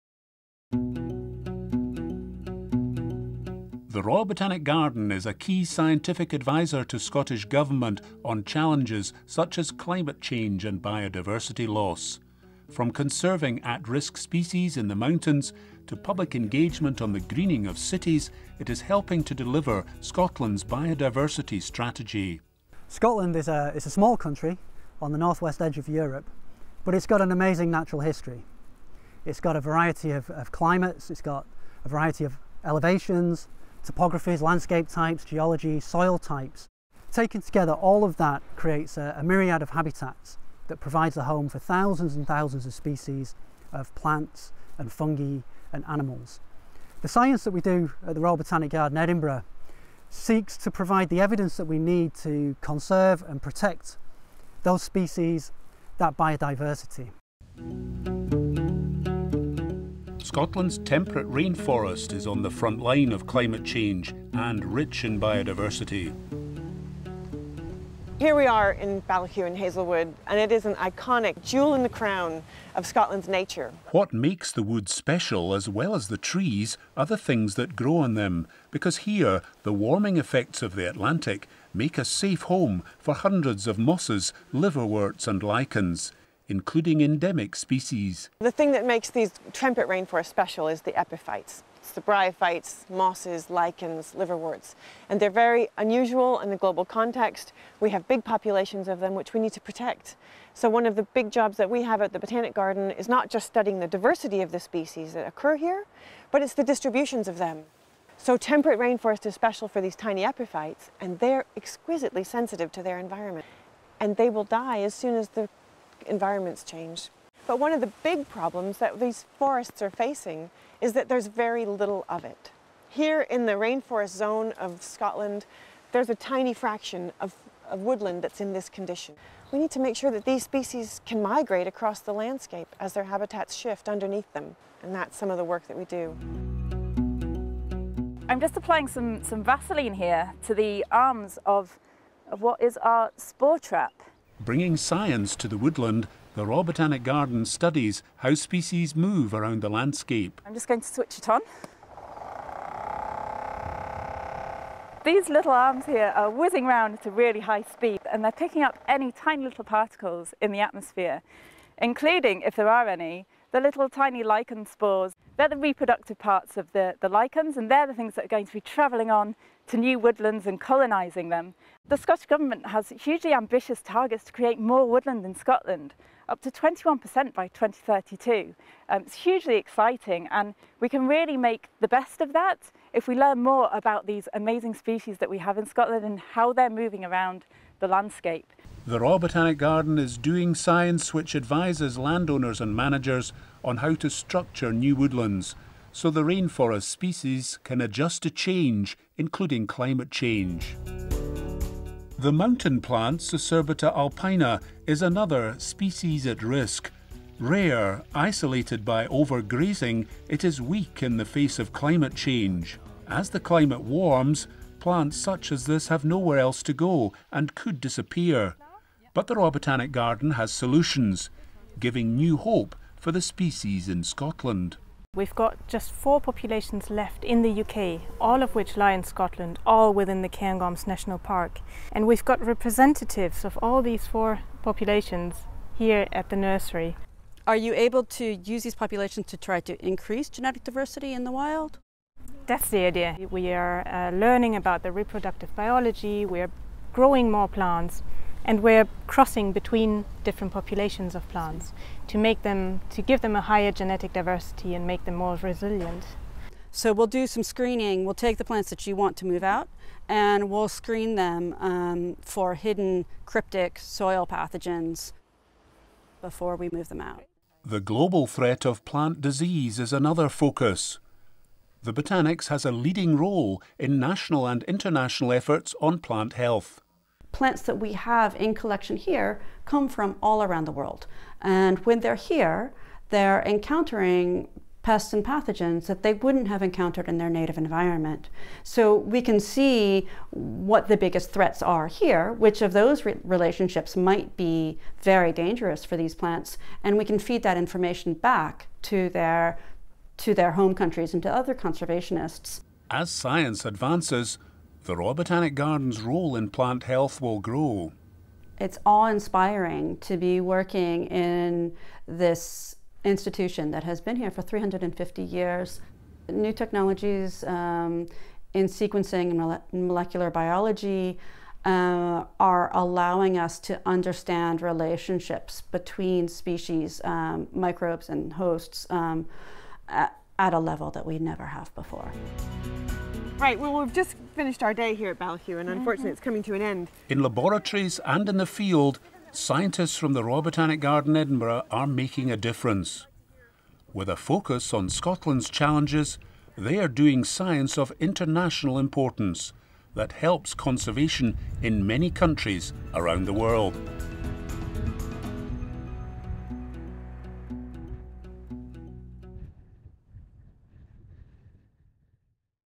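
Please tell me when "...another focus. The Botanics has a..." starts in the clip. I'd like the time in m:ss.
4:29.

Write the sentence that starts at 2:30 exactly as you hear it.
I'm just going to switch it on.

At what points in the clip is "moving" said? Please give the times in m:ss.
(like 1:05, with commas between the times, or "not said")
3:06.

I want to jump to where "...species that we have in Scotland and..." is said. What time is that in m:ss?
3:04.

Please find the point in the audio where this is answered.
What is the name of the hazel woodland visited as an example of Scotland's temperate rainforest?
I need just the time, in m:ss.
1:09.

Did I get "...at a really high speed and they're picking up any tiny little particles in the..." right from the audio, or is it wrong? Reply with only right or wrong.
right.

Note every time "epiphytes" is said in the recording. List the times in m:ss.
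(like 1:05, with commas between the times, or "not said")
1:30, 1:50.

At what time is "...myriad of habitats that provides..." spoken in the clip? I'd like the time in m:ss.
0:39.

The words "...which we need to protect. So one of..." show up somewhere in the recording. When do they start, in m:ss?
1:39.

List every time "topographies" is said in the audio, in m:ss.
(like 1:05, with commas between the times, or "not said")
0:33.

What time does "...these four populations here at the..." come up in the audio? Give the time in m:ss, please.
3:53.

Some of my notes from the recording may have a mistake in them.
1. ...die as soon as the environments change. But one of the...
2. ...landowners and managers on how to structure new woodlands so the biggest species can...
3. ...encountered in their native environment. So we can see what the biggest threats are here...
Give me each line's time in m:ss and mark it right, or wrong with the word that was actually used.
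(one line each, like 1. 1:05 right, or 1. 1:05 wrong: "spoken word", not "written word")
1. 1:54 right
2. 3:11 wrong: "rainforest", not "biggest"
3. 4:46 right.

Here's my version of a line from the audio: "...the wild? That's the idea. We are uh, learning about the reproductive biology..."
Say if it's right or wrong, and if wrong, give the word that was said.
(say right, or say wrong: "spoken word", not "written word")
right.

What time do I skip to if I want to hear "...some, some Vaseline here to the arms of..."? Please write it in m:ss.
2:18.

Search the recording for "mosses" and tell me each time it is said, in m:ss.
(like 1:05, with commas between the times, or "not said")
1:23, 1:32.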